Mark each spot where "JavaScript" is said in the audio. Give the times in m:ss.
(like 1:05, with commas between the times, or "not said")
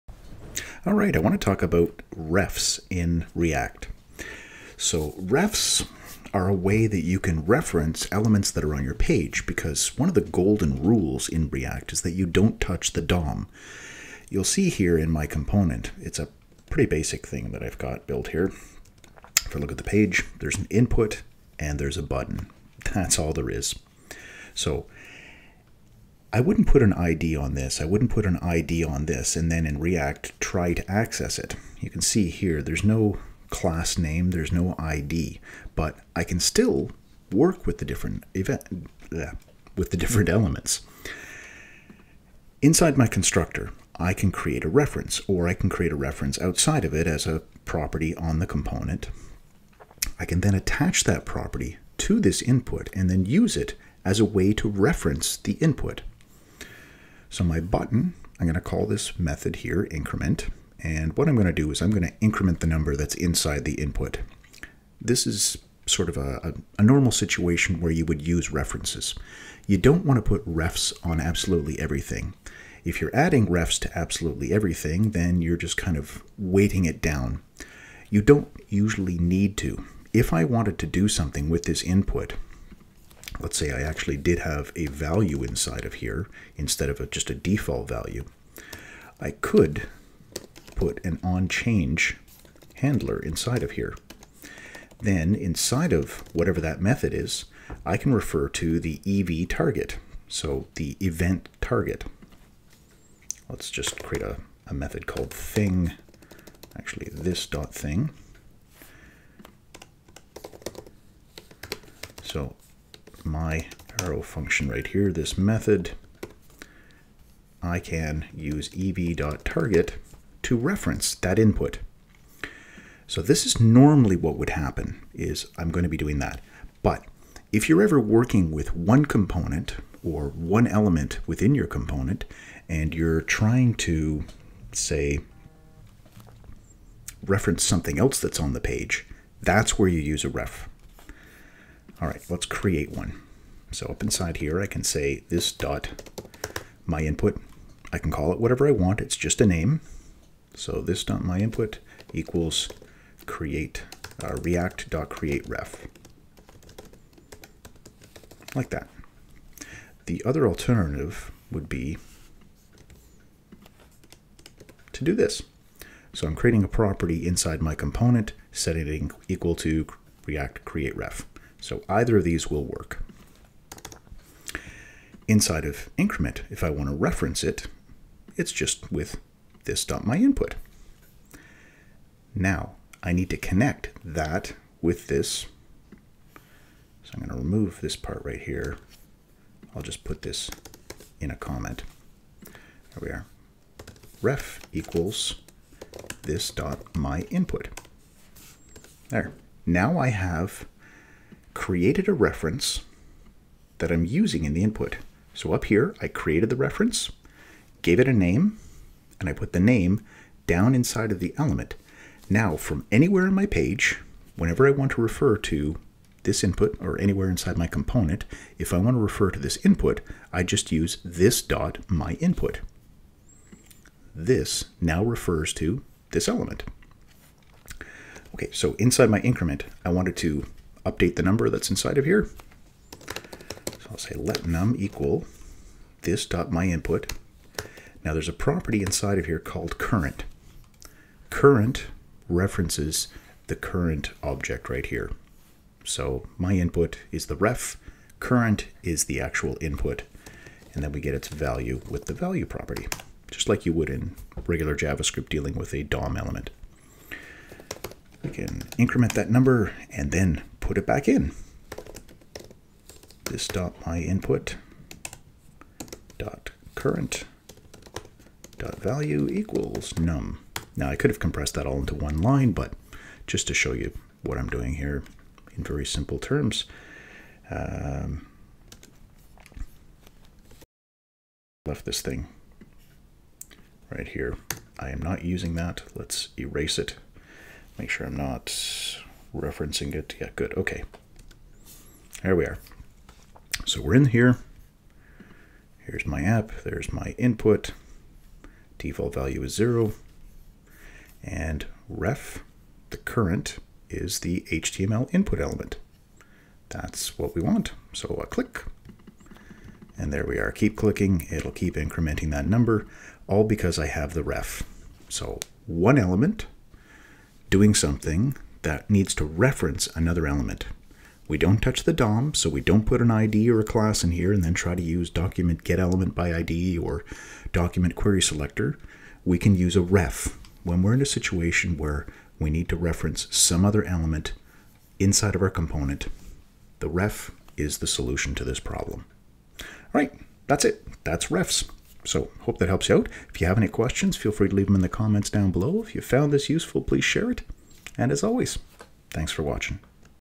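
4:14.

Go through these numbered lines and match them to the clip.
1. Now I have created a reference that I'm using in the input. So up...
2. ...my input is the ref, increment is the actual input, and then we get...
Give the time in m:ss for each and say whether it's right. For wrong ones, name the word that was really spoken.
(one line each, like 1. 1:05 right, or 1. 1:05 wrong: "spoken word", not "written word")
1. 3:19 right
2. 4:06 wrong: "current", not "increment".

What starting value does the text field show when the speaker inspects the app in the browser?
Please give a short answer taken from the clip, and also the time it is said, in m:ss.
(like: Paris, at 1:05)
0, at 4:59.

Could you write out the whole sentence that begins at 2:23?
So up inside here, I can say this dot my input.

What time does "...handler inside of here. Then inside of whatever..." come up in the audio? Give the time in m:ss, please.
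1:32.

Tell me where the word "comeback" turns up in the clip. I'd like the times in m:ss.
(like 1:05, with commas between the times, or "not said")
not said.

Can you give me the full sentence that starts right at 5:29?
We can use a ref when we're in a situation where we need to reference some other element inside of our component.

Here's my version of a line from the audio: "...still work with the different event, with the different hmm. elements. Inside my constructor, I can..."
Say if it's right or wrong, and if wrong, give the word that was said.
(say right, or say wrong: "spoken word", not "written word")
right.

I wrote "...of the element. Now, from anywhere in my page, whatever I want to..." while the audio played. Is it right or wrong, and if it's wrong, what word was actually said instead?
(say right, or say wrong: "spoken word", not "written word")
wrong: "whenever", not "whatever".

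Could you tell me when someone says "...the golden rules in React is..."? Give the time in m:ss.
0:10.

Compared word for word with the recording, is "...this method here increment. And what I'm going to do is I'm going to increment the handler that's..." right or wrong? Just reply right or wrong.
wrong.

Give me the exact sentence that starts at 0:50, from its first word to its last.
I can then attach that property to this input and then use it as a way to reference the input.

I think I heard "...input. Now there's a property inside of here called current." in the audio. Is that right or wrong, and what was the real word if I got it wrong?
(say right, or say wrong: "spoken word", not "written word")
right.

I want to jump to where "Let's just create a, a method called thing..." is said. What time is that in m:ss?
1:43.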